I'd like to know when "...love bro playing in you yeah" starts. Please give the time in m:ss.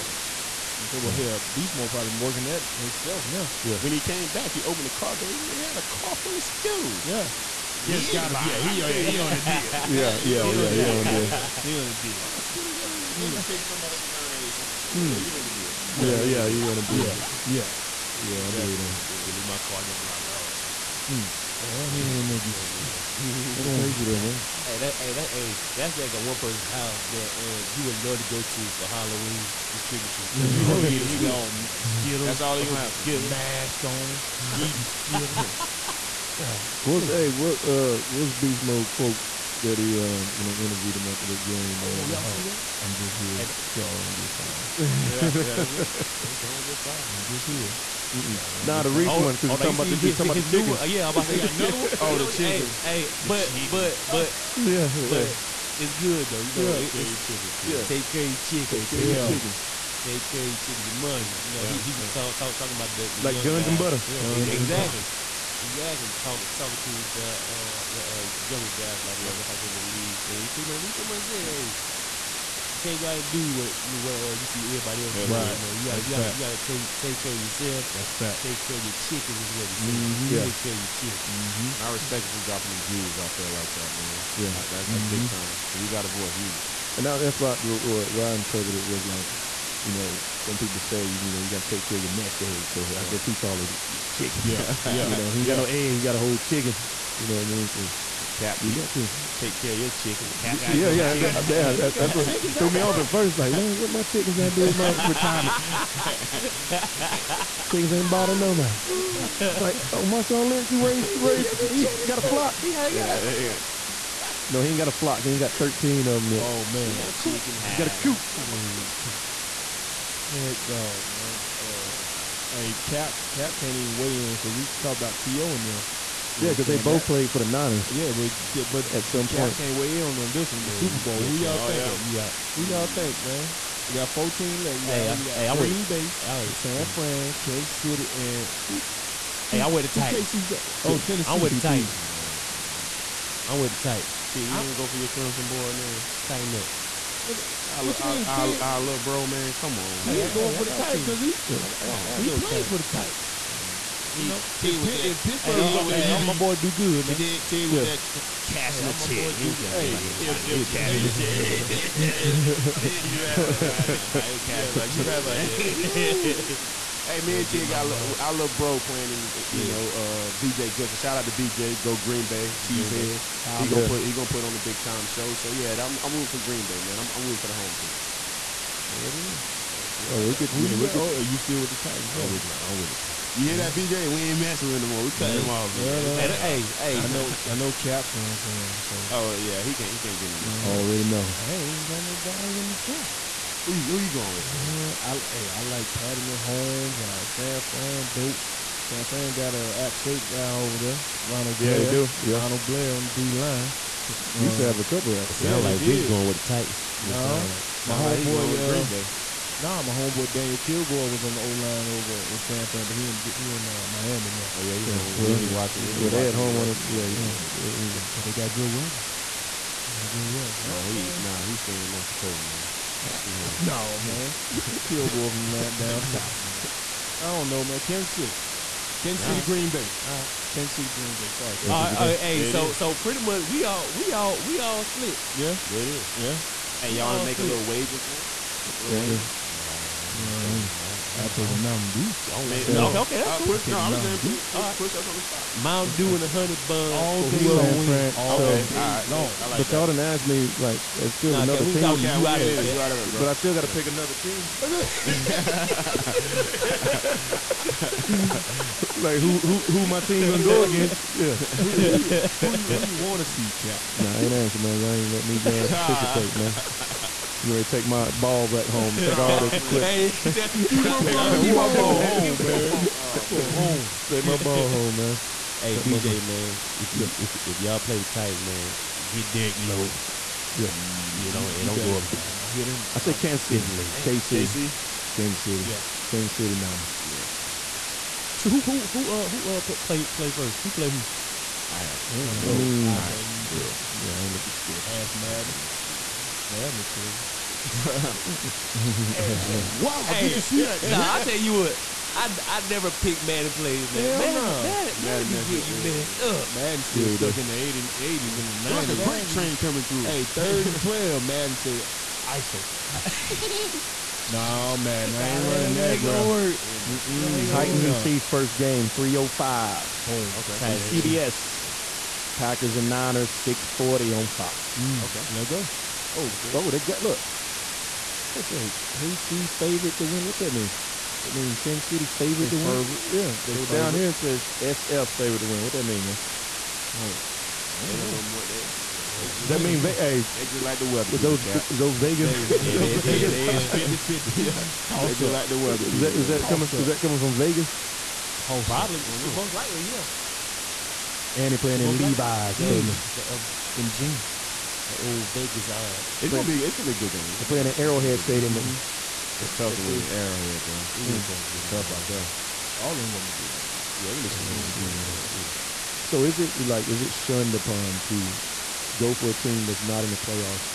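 2:48.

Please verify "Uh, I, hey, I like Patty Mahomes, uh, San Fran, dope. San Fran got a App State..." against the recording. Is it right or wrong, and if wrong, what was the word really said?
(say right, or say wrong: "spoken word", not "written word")
right.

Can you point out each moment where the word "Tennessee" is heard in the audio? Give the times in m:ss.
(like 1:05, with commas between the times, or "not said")
2:20.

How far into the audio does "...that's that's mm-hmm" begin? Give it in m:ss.
1:24.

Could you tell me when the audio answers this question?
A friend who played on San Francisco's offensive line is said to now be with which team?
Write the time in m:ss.
3:33.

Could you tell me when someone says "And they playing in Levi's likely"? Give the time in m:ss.
5:51.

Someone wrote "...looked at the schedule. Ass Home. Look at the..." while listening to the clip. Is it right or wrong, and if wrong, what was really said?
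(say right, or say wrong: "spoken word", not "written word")
wrong: "Madden", not "Home".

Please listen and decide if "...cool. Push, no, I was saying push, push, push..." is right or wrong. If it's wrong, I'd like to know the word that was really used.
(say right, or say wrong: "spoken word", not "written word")
right.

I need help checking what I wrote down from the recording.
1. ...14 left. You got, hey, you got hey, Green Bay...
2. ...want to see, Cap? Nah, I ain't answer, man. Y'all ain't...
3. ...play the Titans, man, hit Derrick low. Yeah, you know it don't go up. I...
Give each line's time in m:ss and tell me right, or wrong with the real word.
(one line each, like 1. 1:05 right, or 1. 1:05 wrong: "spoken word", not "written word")
1. 2:14 right
2. 4:23 right
3. 4:37 right.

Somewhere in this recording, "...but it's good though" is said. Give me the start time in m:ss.
0:54.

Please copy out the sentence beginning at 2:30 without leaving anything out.
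going hey, for the Titans because he he played for the Titans.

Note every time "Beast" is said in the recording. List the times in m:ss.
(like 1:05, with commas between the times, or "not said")
0:01, 0:38.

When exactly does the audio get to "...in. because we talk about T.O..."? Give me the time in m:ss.
2:04.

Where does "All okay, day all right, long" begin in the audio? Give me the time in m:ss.
4:08.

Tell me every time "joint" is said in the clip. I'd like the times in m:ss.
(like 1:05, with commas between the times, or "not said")
not said.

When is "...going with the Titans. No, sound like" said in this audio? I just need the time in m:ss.
3:26.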